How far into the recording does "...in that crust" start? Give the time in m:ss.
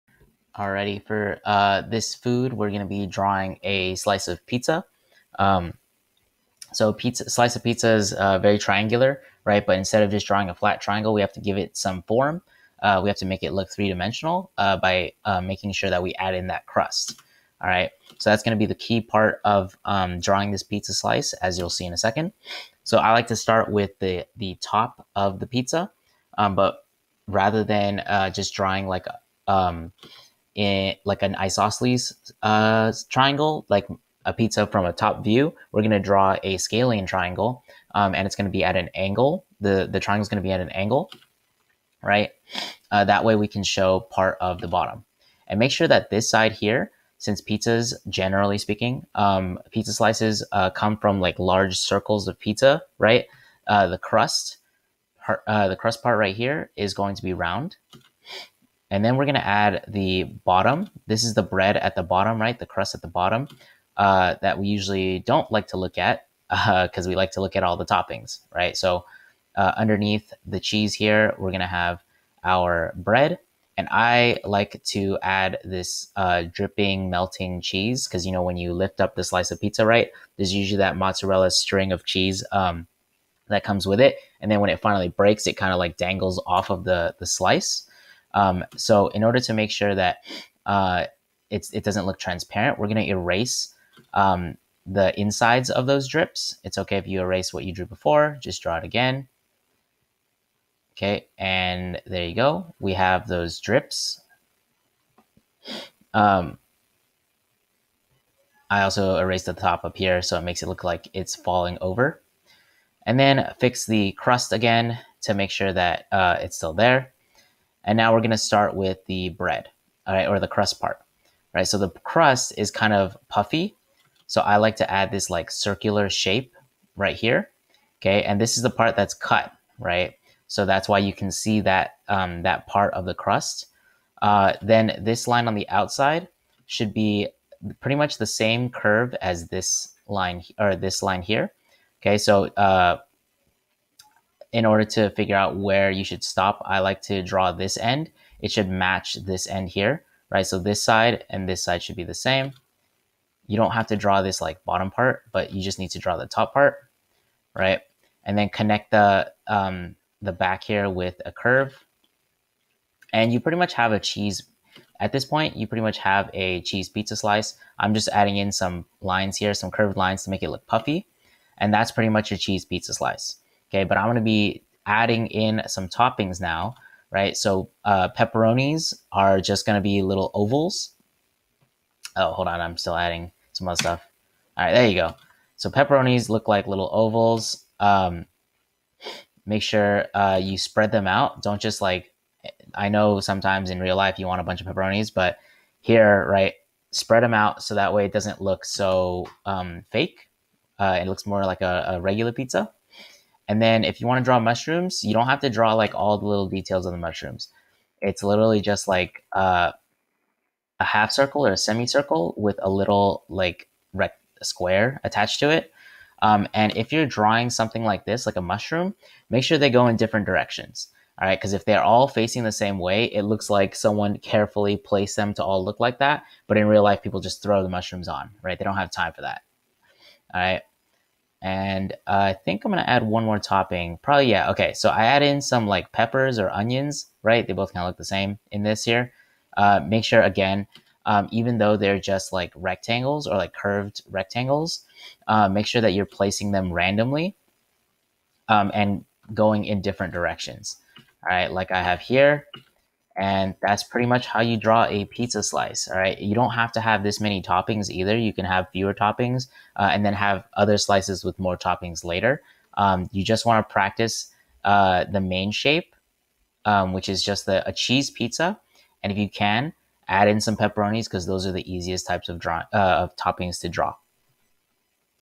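0:16.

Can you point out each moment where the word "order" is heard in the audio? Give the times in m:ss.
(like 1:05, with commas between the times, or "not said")
1:29, 2:24.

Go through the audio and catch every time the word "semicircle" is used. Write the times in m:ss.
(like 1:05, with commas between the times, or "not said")
3:31.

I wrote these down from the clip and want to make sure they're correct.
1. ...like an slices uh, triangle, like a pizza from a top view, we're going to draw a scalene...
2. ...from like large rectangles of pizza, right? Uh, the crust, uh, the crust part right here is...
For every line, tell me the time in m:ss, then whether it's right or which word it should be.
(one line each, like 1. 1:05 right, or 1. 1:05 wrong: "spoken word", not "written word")
1. 0:31 wrong: "isosceles", not "slices"
2. 0:50 wrong: "circles", not "rectangles".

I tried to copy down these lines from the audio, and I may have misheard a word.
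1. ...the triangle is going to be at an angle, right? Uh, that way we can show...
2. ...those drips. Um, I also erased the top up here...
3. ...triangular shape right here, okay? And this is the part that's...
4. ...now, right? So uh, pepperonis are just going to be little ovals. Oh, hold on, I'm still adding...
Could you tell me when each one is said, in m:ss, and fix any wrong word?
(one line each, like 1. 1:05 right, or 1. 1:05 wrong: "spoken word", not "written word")
1. 0:39 right
2. 1:43 right
3. 2:05 wrong: "circular", not "triangular"
4. 2:56 right.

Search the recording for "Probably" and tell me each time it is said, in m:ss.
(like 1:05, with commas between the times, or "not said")
3:54.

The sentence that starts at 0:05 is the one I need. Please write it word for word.
Um, so pizza slice of pizza is uh, very triangular, right?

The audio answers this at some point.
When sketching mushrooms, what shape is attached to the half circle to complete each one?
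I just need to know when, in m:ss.
3:34.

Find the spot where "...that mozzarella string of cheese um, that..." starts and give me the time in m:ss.
1:20.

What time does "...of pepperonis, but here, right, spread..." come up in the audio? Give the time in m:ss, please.
3:14.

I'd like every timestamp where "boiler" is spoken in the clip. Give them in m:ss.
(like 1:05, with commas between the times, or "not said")
not said.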